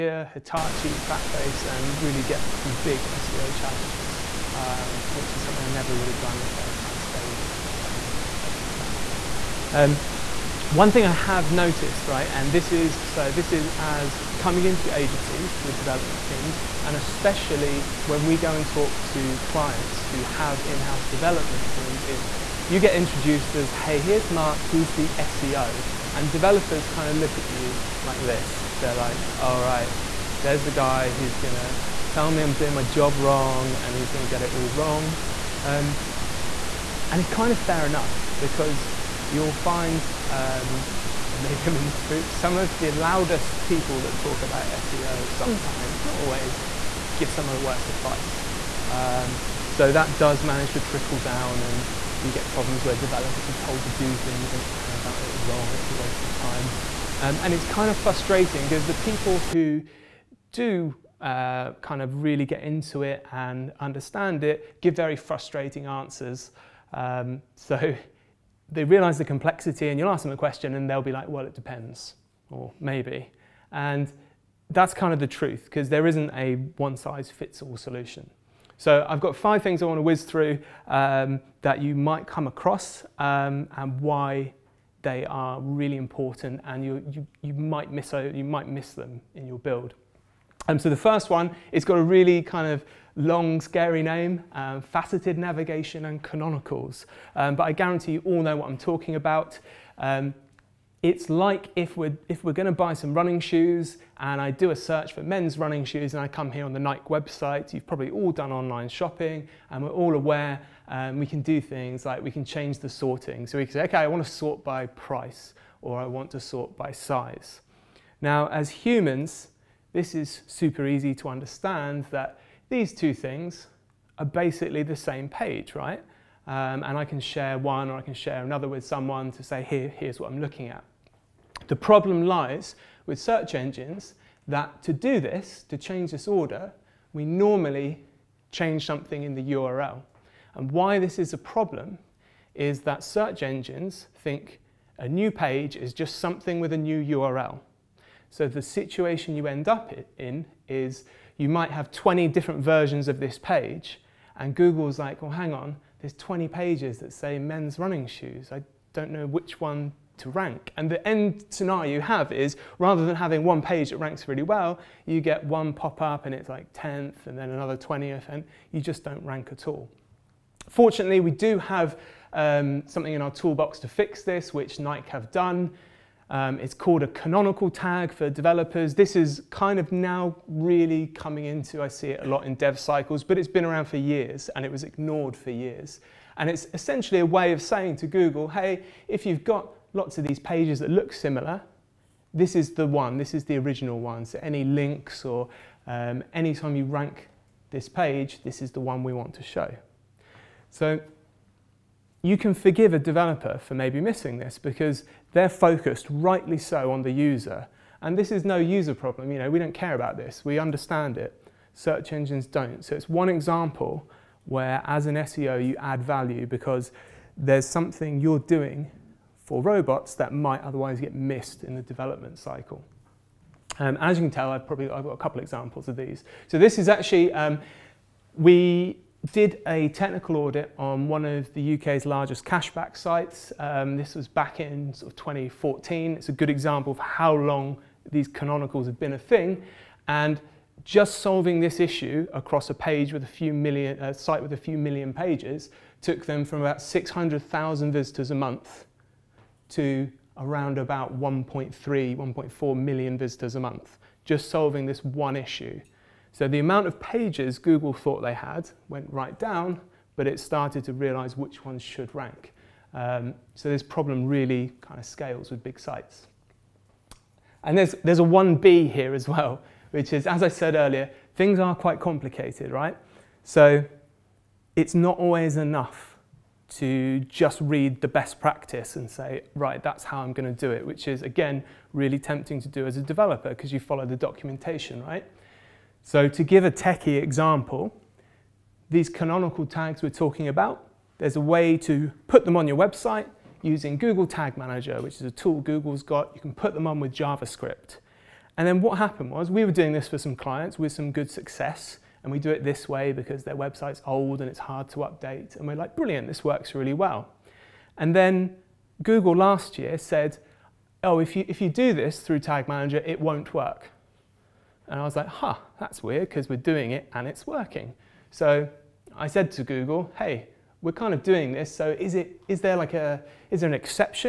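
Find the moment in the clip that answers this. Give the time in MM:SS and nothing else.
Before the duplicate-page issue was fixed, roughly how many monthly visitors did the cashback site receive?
04:06.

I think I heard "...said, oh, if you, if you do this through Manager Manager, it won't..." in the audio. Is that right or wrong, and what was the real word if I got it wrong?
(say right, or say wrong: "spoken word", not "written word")
wrong: "Tag", not "Manager".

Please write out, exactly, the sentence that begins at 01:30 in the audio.
Um, so the first one, it's got a really kind of long, scary name, um, faceted navigation and canonicals.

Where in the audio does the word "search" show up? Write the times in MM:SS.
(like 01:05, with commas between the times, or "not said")
01:44, 02:13, 02:23, 03:31.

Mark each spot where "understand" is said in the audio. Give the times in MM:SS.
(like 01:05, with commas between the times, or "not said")
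01:03, 02:01, 03:30.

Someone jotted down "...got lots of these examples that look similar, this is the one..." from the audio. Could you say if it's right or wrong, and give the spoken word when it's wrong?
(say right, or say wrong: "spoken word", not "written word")
wrong: "pages", not "examples".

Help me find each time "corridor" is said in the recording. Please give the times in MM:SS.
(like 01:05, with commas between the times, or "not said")
not said.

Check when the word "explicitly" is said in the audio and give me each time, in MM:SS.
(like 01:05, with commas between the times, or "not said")
not said.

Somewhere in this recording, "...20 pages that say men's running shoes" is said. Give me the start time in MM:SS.
02:36.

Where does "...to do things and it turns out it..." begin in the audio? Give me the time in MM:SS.
00:53.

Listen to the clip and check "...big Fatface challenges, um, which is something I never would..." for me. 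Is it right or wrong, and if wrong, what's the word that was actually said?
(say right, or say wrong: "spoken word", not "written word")
wrong: "SEO", not "Fatface".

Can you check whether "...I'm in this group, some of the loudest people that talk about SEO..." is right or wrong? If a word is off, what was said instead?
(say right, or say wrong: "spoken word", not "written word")
right.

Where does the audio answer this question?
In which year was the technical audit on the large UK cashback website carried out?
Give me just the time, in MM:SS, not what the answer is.
03:55.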